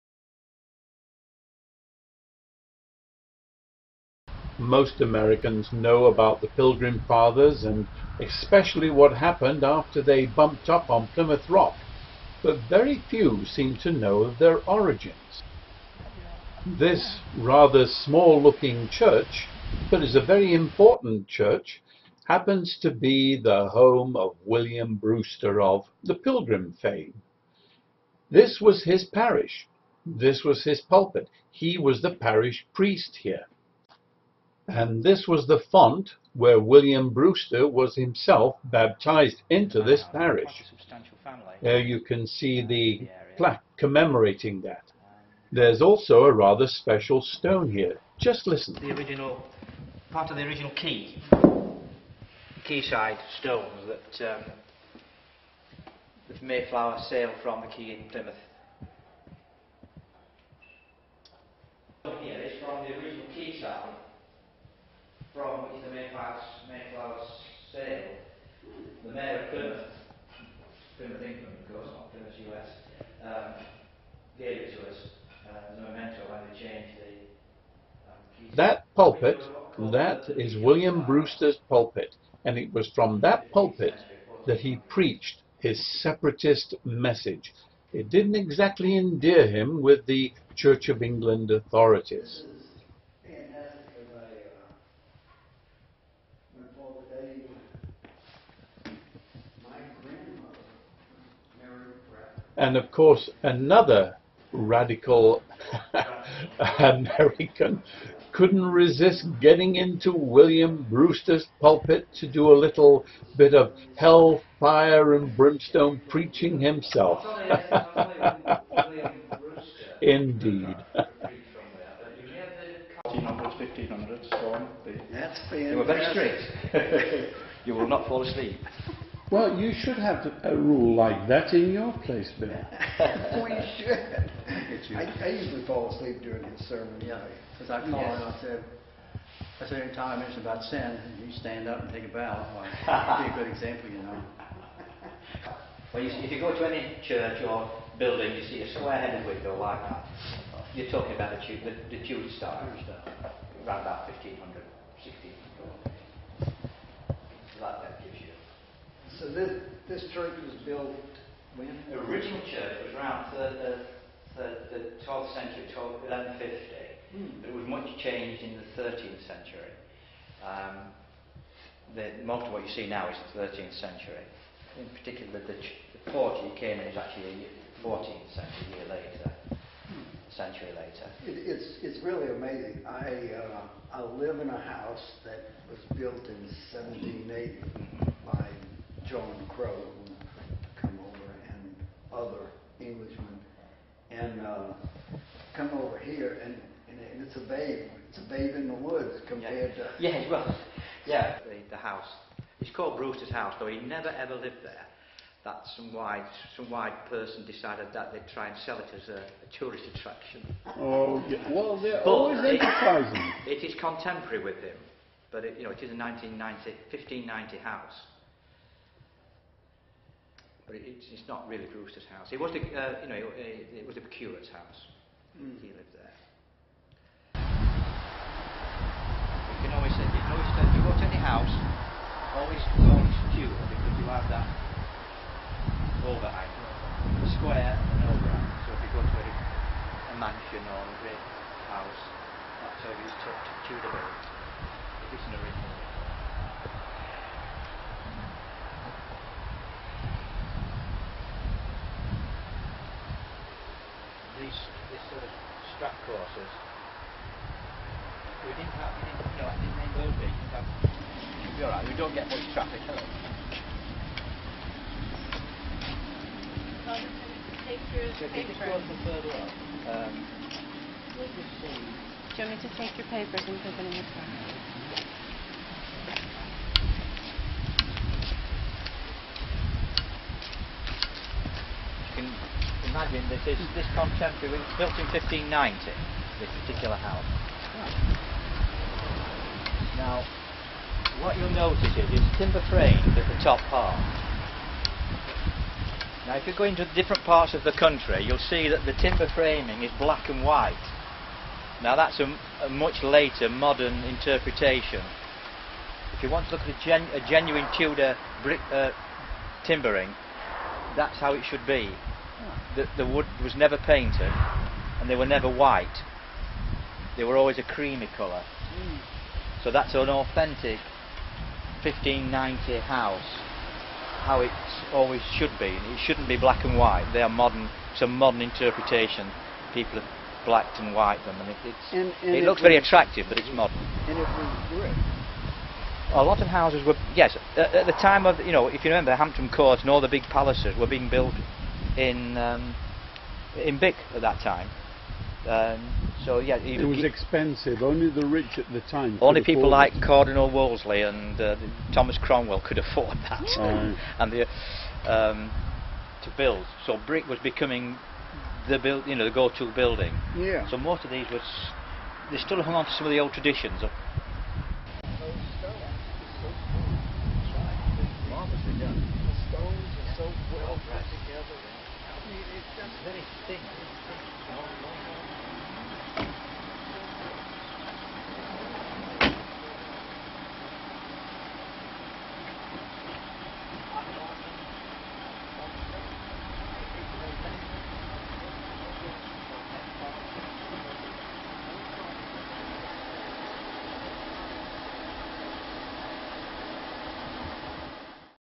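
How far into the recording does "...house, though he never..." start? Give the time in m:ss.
3:23.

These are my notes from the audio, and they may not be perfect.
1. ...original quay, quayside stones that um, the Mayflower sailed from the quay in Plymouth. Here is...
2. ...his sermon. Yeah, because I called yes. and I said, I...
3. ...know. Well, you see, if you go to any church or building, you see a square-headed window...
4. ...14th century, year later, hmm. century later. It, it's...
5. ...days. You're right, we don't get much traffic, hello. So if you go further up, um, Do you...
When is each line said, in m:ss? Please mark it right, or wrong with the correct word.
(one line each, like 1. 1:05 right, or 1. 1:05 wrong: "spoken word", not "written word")
1. 0:50 right
2. 2:16 right
3. 2:24 right
4. 2:57 right
5. 4:20 right.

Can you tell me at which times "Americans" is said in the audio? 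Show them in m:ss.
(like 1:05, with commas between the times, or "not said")
0:05, 1:46.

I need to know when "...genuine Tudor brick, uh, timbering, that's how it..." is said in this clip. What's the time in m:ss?
5:07.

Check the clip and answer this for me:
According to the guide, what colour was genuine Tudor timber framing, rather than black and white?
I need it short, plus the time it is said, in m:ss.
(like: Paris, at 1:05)
Creamy, at 5:17.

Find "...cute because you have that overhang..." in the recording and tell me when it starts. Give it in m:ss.
3:53.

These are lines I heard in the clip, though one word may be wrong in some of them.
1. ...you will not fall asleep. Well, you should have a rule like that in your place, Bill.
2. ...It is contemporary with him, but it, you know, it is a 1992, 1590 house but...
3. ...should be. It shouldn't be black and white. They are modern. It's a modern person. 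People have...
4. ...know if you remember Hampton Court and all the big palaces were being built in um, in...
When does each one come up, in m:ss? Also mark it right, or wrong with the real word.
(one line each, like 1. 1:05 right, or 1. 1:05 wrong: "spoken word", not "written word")
1. 2:07 right
2. 3:33 wrong: "1990", not "1992"
3. 5:25 wrong: "interpretation", not "person"
4. 5:38 right.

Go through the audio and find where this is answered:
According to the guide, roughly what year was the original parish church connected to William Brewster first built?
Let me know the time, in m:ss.
2:46.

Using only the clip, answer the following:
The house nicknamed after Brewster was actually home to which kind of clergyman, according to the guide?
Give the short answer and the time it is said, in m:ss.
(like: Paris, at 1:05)
The curate, at 3:44.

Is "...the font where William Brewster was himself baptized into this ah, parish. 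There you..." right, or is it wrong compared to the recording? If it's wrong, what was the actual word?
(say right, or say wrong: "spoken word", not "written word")
right.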